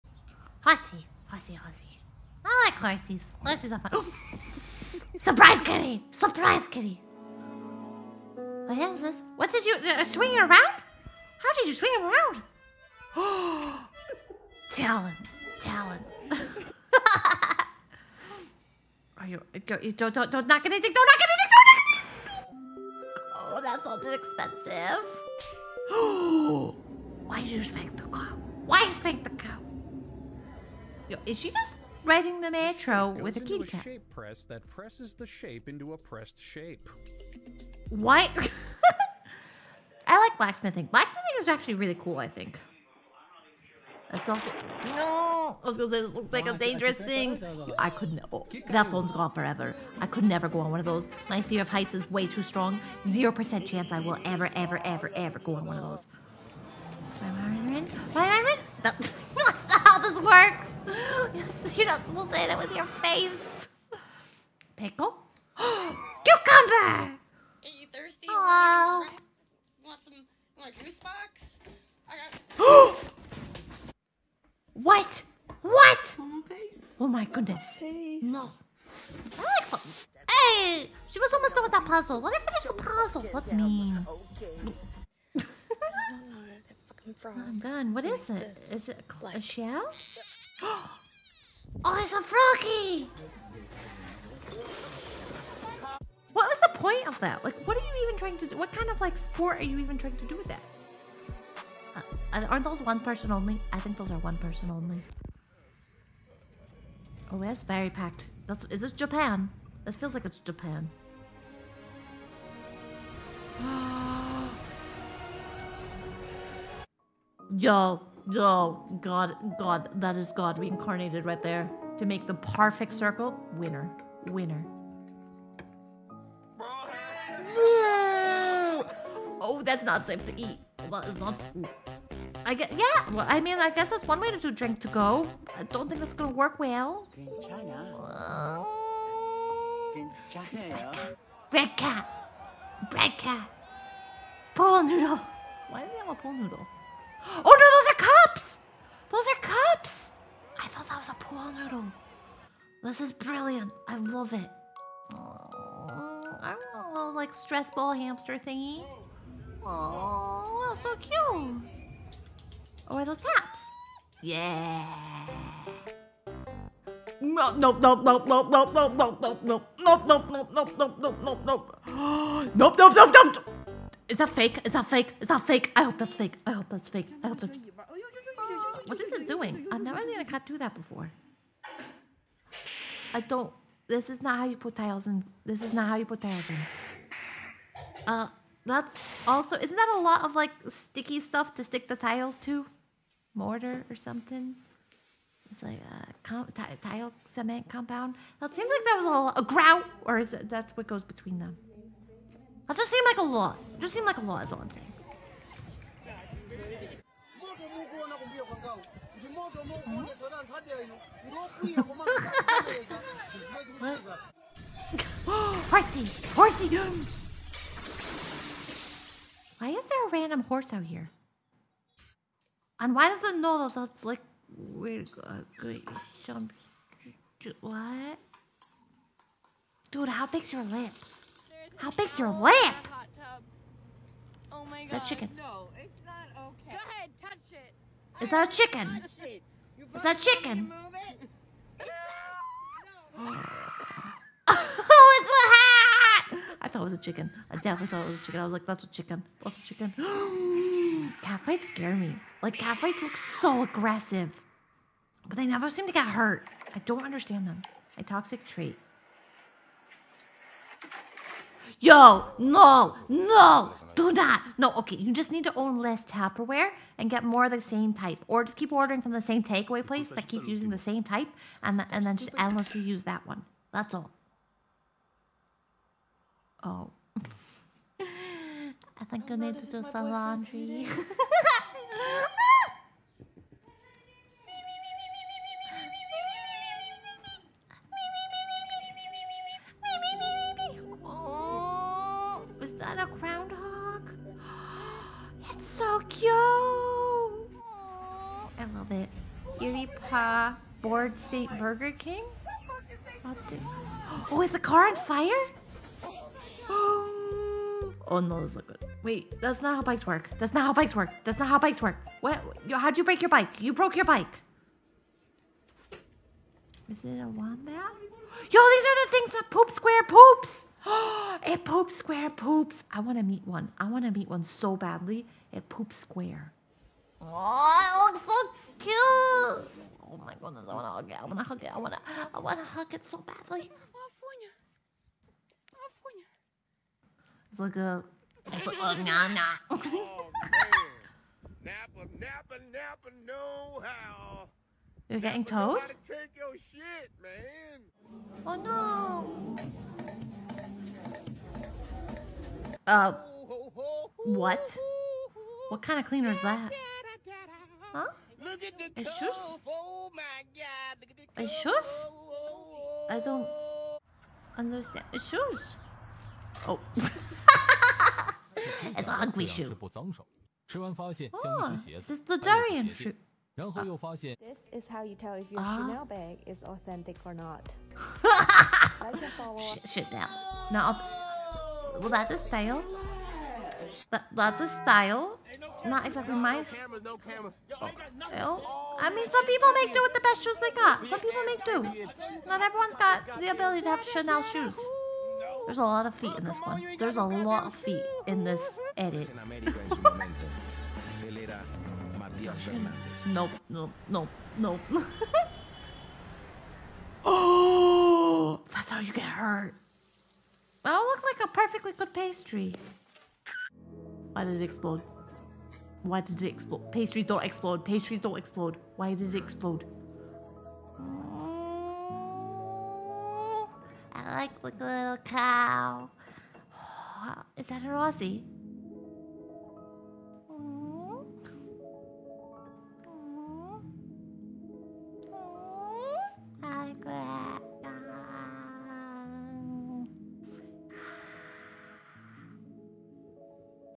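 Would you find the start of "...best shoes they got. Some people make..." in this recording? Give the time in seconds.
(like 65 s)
390 s.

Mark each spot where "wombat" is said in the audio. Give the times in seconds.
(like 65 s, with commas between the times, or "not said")
317 s.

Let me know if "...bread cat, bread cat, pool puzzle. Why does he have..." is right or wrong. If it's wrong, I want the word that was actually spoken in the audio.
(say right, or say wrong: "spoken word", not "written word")
wrong: "noodle", not "puzzle".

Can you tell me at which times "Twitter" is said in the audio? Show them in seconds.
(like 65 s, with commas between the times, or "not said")
not said.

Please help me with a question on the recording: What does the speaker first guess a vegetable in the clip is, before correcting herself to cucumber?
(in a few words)
Pickle.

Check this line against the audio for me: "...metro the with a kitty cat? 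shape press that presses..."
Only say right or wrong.
right.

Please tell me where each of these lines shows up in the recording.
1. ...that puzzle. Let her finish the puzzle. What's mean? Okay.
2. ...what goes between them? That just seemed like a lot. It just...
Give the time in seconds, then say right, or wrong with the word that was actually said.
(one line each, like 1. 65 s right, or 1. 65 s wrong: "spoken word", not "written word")
1. 81 s right
2. 200 s right.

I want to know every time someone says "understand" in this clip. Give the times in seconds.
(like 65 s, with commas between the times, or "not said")
257 s, 364 s.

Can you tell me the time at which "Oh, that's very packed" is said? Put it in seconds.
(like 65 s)
107 s.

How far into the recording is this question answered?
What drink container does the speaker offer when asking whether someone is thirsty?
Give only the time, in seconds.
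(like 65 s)
70 s.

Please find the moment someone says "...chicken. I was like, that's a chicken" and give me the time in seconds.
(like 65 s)
248 s.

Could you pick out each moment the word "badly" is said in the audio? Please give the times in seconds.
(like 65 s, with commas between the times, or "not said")
324 s, 333 s.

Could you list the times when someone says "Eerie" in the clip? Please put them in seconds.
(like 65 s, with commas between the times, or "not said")
299 s.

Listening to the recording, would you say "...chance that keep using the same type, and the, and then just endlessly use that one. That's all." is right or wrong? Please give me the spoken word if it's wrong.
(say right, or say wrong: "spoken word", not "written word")
wrong: "place", not "chance".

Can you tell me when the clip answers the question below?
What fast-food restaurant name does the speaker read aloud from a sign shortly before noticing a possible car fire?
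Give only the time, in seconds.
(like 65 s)
301 s.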